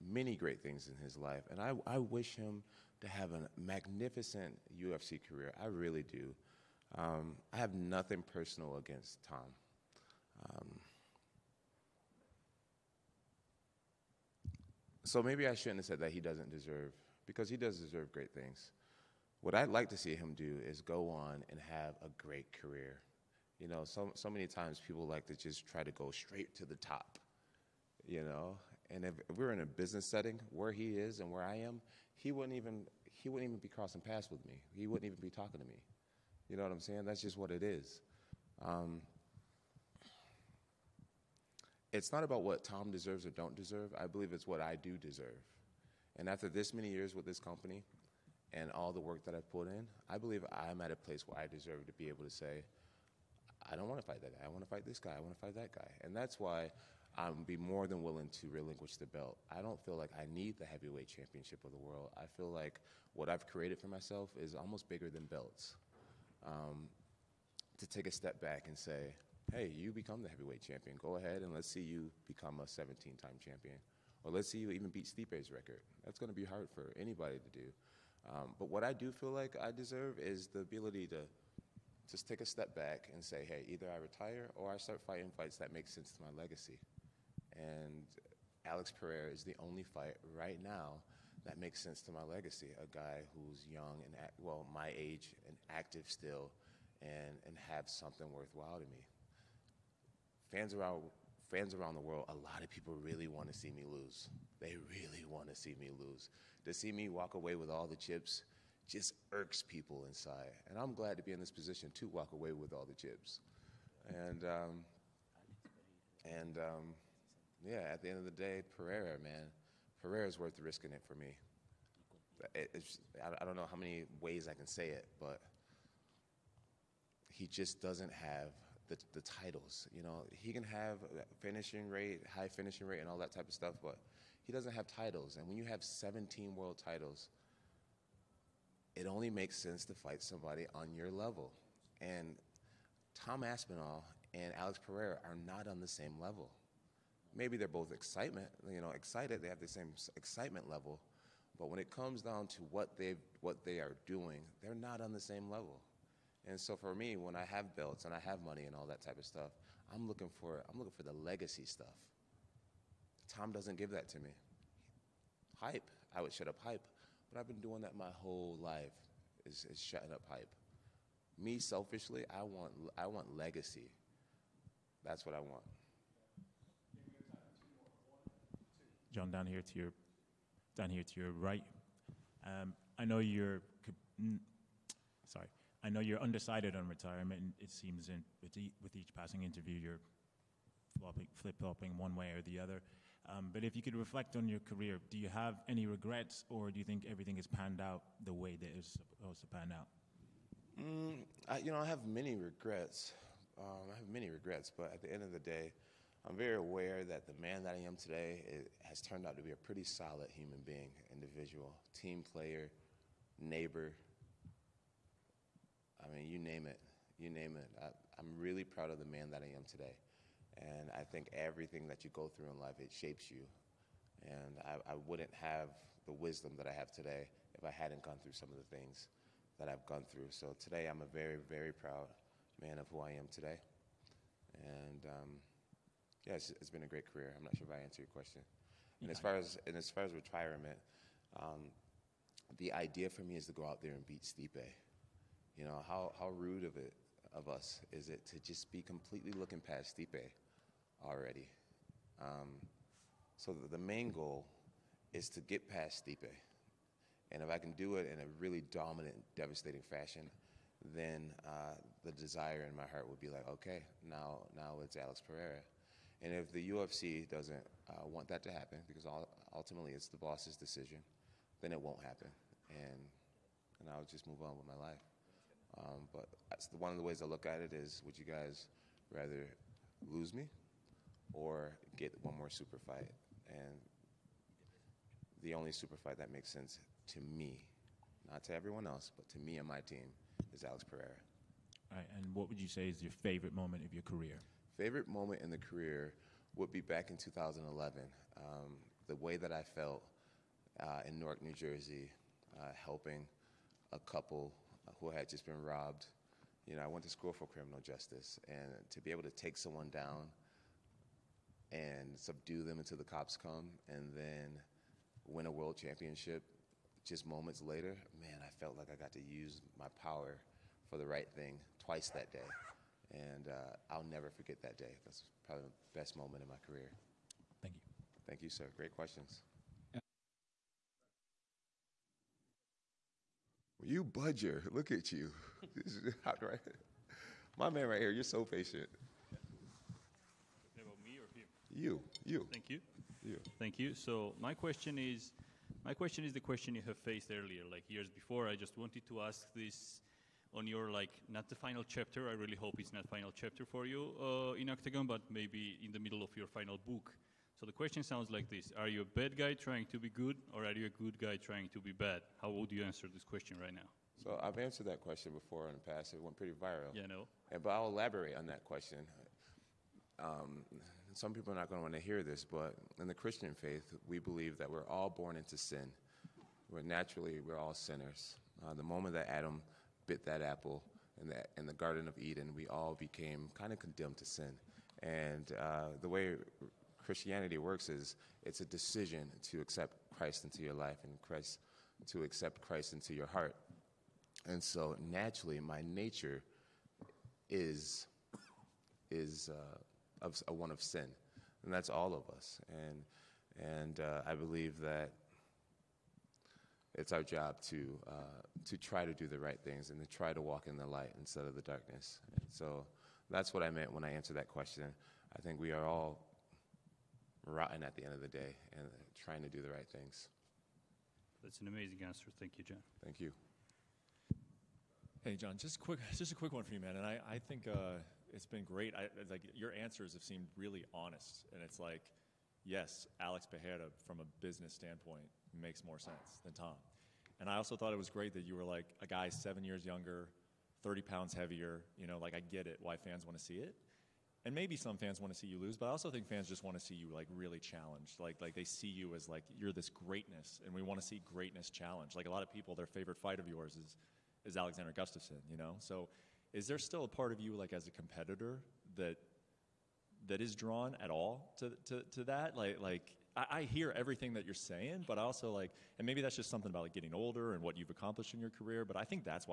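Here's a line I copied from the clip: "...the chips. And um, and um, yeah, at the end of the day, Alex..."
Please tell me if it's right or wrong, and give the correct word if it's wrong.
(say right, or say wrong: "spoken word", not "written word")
wrong: "Pereira", not "Alex".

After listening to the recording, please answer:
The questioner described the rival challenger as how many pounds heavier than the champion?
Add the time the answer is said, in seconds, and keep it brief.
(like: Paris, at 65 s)
30, at 440 s.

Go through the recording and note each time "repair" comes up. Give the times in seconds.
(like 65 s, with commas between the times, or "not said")
not said.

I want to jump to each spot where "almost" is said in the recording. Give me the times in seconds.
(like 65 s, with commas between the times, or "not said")
64 s.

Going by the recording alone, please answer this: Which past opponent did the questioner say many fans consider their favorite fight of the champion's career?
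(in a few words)
Alexander Gustafsson.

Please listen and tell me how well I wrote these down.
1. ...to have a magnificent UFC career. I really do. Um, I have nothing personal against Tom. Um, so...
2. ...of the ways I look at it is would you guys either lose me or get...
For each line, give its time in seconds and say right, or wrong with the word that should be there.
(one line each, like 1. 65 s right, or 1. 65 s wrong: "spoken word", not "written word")
1. 2 s right
2. 276 s wrong: "rather", not "either".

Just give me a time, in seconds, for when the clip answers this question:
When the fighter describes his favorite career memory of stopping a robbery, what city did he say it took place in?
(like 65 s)
301 s.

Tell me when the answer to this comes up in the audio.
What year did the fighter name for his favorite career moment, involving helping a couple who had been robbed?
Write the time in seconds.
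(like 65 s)
297 s.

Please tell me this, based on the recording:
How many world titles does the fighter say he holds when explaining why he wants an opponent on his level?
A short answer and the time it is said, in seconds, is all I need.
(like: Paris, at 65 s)
17, at 135 s.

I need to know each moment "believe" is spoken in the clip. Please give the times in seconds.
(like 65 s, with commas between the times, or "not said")
44 s, 50 s, 374 s, 404 s.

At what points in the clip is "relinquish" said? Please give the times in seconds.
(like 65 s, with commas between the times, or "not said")
58 s.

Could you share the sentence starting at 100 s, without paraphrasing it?
Fans around fans around the world, a lot of people really want to see me lose.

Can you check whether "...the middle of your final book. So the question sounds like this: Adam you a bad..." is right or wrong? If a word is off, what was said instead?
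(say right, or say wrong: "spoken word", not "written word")
wrong: "Are", not "Adam".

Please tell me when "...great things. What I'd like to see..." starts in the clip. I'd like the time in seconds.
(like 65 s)
18 s.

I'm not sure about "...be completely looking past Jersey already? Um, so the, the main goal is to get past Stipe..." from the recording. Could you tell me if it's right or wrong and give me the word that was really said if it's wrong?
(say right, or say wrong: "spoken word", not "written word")
wrong: "Stipe", not "Jersey".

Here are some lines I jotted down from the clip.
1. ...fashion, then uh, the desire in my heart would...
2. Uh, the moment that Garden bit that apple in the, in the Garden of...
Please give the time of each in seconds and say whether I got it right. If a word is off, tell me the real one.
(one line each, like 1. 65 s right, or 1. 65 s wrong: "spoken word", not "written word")
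1. 259 s right
2. 378 s wrong: "Adam", not "Garden".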